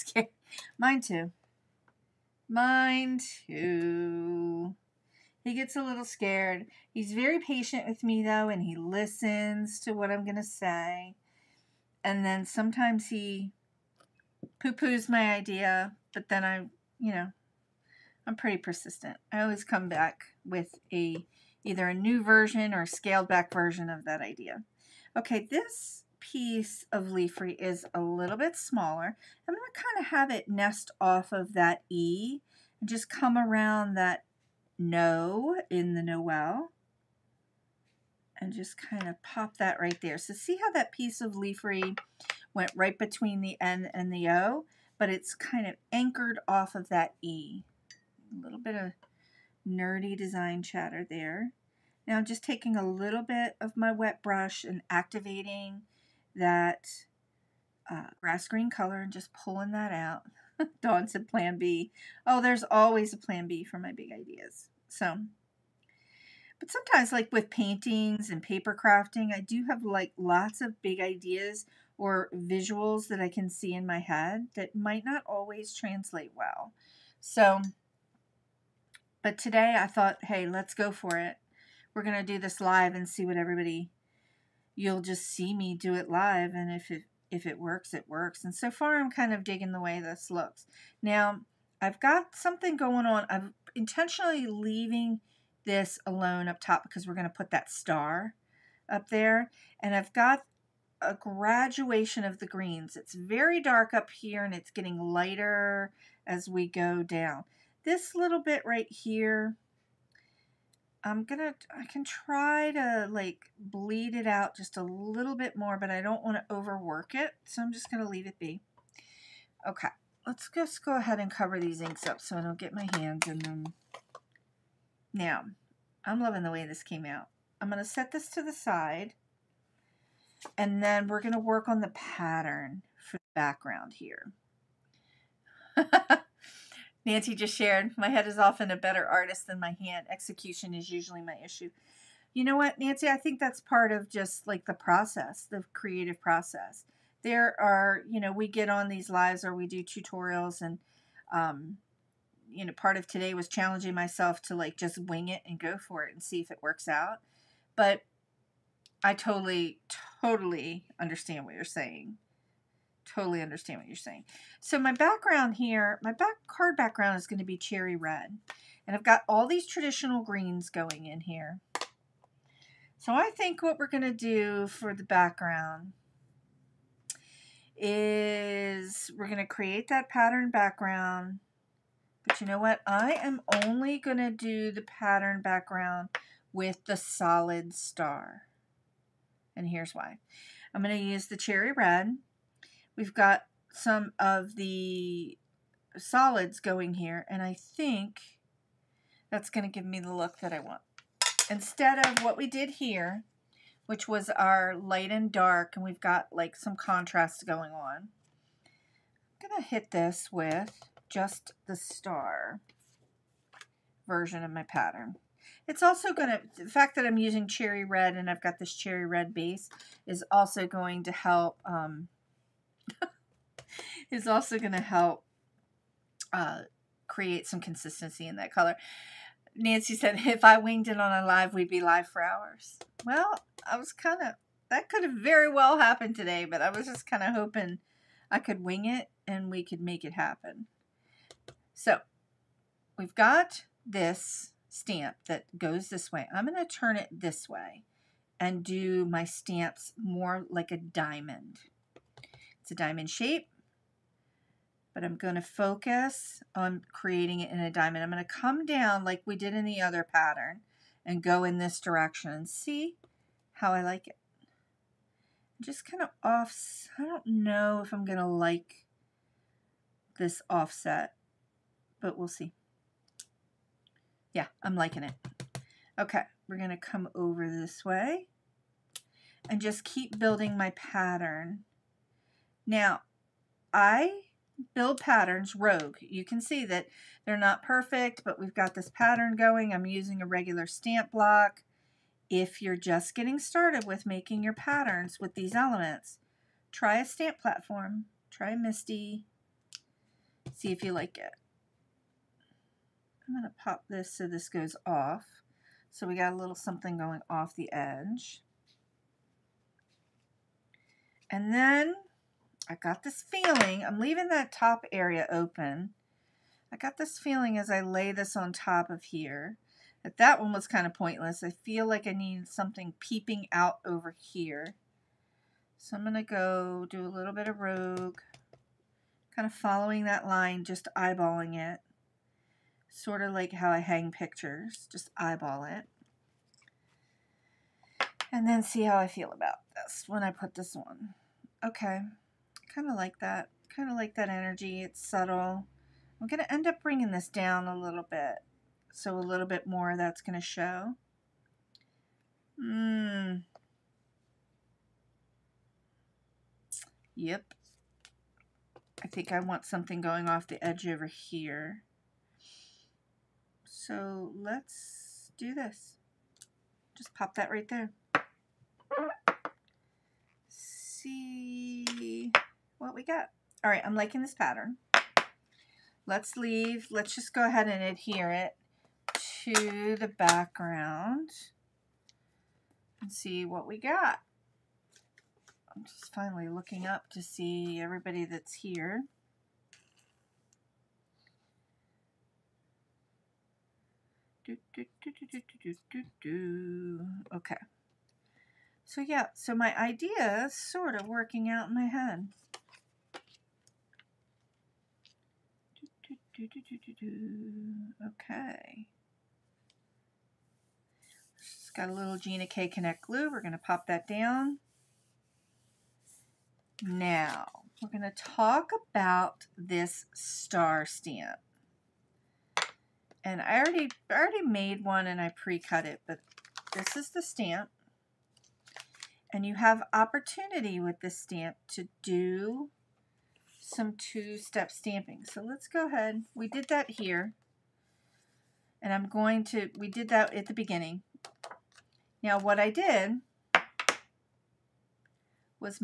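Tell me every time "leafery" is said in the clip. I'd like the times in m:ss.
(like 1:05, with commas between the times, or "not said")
0:27, 0:41.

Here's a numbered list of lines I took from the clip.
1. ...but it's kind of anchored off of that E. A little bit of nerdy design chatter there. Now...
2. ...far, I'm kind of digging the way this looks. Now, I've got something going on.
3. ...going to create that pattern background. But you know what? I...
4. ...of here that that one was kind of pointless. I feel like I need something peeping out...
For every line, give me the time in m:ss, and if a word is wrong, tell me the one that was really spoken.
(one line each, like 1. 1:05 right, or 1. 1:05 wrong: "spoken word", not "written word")
1. 0:44 right
2. 1:28 right
3. 2:59 right
4. 5:18 right.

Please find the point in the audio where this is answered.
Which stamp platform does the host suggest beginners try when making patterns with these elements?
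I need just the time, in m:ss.
4:58.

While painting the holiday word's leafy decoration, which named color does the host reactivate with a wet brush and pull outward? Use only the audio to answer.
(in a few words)
grass green.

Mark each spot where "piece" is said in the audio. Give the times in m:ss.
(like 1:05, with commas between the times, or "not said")
0:26, 0:40.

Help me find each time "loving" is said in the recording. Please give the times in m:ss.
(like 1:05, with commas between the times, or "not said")
2:06.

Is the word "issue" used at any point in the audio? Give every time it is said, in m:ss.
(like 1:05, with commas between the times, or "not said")
2:21.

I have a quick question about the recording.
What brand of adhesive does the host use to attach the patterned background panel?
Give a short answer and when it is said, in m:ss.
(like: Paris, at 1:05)
Gina K Connect glue, at 6:52.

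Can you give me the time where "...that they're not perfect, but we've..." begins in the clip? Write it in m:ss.
4:46.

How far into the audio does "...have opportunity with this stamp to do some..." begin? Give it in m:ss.
7:09.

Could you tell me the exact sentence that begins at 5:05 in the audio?
So we got a little something going off the edge.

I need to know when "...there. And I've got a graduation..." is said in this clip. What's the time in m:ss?
1:39.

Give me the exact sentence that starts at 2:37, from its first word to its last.
But I totally, totally understand what you're saying totally understand what you're saying.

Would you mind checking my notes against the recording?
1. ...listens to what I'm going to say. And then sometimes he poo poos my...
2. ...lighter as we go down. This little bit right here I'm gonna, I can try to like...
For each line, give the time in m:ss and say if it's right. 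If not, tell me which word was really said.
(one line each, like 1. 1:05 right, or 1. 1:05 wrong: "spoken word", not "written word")
1. 0:08 right
2. 1:44 right.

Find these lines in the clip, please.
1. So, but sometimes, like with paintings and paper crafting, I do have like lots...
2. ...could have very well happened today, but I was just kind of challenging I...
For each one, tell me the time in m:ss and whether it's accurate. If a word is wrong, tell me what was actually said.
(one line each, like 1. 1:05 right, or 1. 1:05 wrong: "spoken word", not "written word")
1. 1:04 right
2. 3:54 wrong: "hoping", not "challenging".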